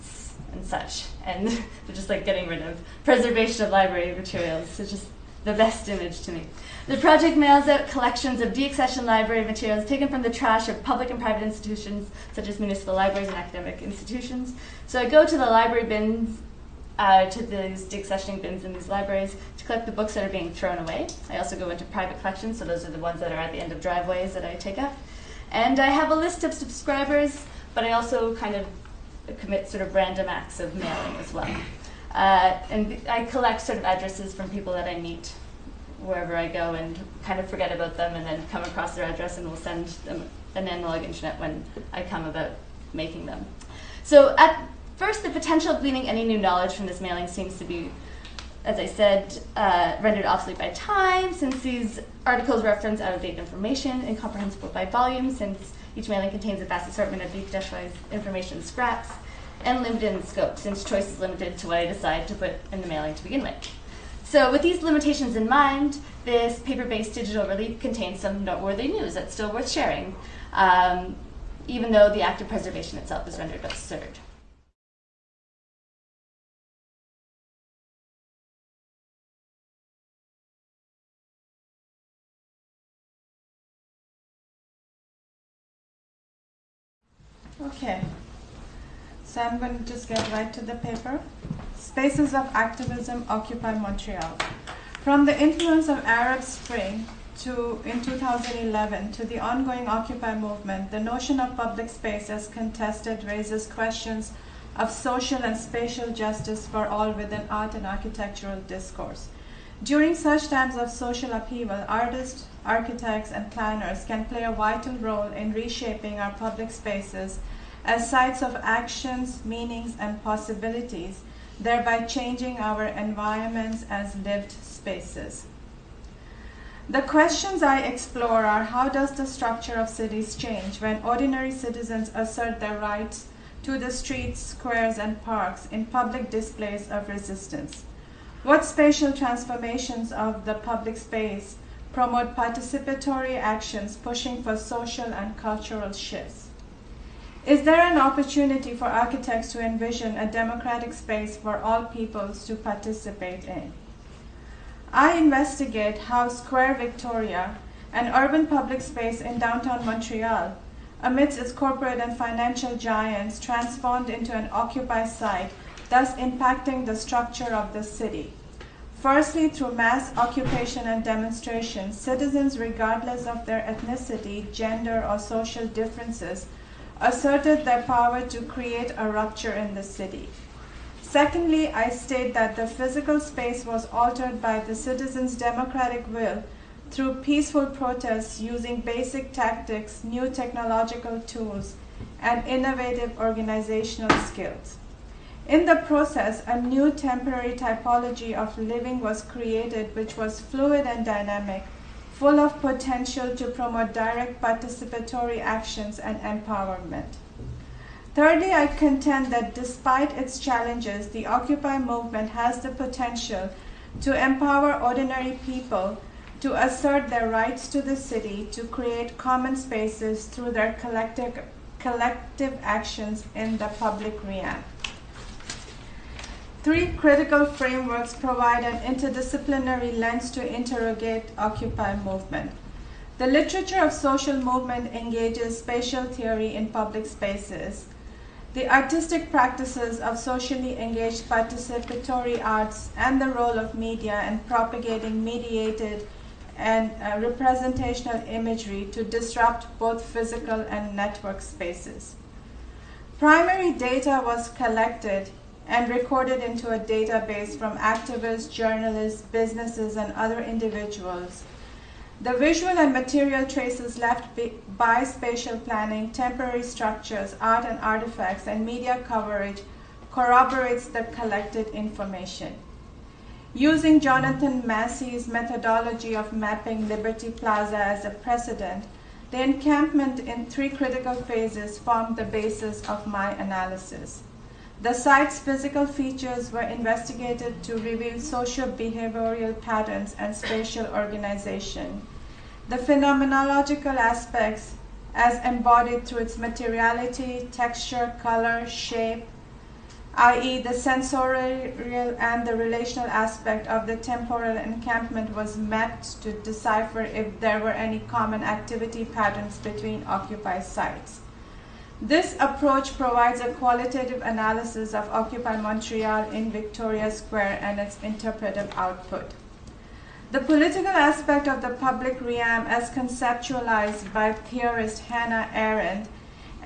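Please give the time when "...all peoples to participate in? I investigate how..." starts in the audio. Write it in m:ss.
2:31.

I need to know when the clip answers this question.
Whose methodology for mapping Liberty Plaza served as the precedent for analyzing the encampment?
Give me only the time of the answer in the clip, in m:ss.
4:33.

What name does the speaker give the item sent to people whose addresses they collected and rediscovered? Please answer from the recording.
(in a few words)
an analog internet.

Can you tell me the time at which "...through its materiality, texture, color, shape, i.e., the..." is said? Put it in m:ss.
4:56.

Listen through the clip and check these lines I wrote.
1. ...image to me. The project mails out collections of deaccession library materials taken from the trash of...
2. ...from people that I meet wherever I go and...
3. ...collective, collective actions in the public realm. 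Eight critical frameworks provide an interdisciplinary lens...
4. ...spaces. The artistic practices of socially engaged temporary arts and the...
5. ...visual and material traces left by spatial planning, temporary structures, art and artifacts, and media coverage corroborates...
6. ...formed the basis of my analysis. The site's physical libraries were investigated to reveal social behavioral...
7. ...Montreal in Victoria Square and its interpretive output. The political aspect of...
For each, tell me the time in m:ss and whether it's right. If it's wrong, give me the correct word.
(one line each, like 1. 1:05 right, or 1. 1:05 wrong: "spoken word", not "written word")
1. 0:05 right
2. 0:34 right
3. 3:40 wrong: "Three", not "Eight"
4. 3:57 wrong: "participatory", not "temporary"
5. 4:22 right
6. 4:41 wrong: "features", not "libraries"
7. 5:15 right.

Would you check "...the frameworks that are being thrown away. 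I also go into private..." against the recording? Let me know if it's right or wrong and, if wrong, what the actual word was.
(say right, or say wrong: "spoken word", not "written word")
wrong: "books", not "frameworks".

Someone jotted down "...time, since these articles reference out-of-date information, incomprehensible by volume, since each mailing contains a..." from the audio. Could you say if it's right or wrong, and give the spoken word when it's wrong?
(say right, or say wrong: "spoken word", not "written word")
right.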